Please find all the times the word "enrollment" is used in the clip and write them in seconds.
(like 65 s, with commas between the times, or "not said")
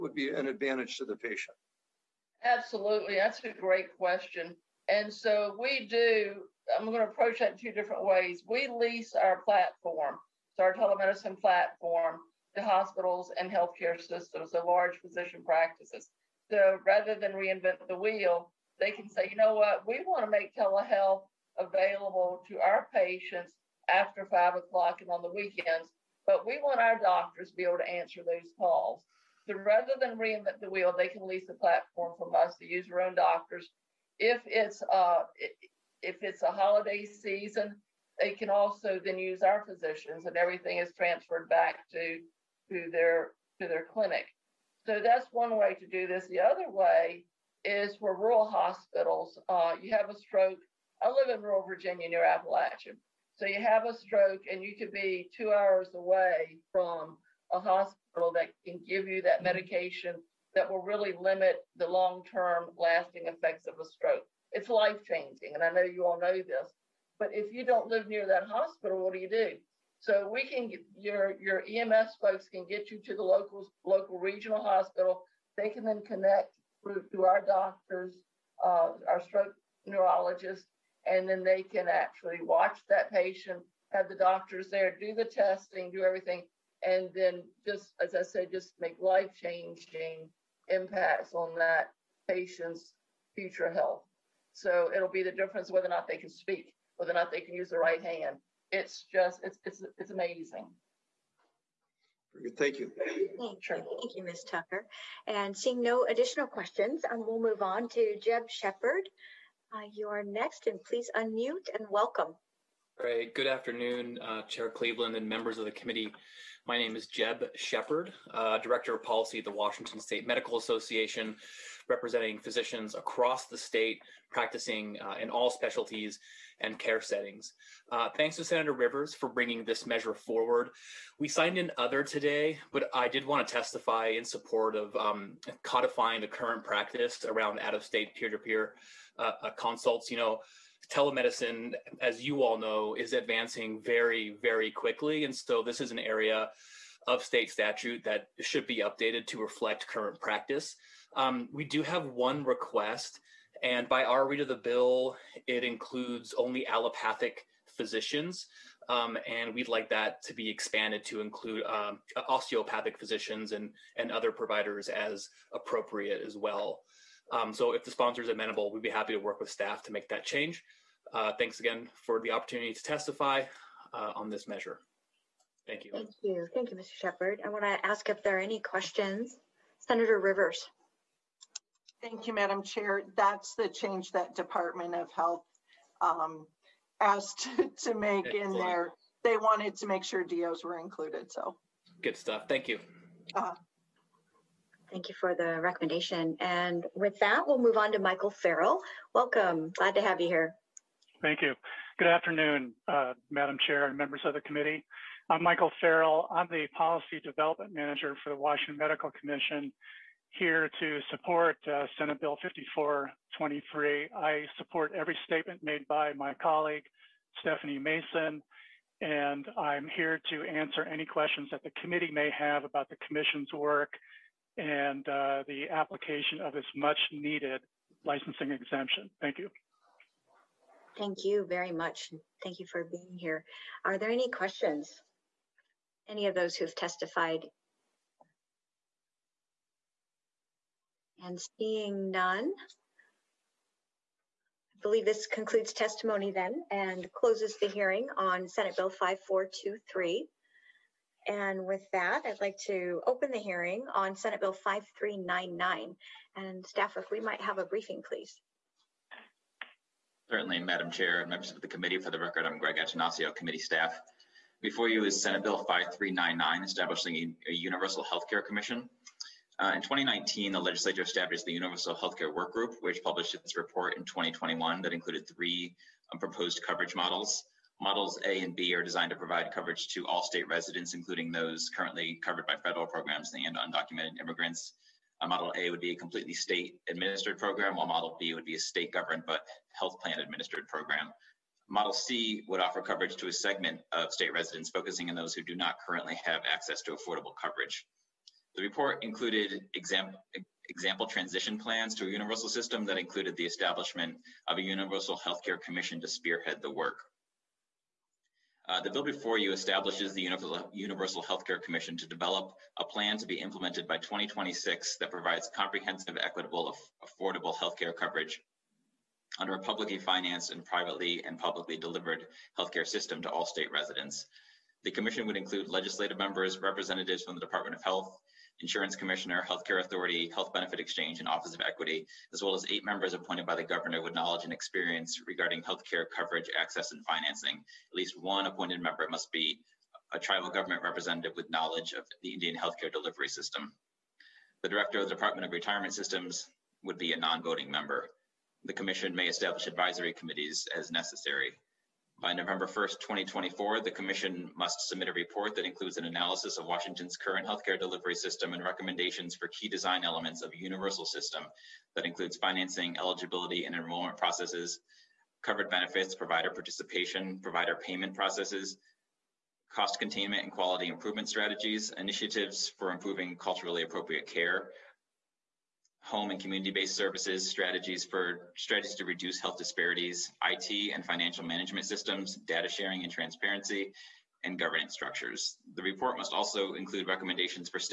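363 s.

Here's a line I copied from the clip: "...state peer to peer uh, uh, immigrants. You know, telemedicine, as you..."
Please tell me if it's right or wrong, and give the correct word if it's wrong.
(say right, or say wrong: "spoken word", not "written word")
wrong: "consults", not "immigrants".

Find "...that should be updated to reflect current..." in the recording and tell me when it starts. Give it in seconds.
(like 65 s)
148 s.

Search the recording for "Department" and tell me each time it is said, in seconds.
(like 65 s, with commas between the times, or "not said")
184 s, 327 s, 345 s.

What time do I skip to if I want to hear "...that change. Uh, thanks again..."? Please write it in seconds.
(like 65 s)
170 s.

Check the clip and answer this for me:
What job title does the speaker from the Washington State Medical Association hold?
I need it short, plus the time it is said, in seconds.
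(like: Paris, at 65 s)
Director of Policy, at 118 s.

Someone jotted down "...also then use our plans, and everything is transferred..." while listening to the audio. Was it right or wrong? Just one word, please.
wrong.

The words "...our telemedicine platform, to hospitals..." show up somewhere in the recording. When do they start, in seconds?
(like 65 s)
10 s.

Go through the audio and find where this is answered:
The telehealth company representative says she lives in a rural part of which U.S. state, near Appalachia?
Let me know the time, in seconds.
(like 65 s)
51 s.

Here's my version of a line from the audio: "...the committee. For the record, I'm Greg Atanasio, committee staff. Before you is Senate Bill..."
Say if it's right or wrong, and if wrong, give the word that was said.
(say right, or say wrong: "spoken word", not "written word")
right.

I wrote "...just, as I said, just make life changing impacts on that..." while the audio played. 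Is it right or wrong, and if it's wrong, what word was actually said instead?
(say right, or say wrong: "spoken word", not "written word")
right.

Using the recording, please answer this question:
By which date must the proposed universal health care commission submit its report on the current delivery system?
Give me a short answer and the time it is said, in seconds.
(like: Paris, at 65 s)
November 1, 2024, at 352 s.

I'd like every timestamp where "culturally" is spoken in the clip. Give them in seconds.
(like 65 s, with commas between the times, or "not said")
373 s.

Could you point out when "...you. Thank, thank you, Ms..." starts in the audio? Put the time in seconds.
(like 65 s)
102 s.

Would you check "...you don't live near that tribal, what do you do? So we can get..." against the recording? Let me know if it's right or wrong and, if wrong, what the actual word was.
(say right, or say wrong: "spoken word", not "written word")
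wrong: "hospital", not "tribal".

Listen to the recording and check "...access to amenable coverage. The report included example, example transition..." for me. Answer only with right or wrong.
wrong.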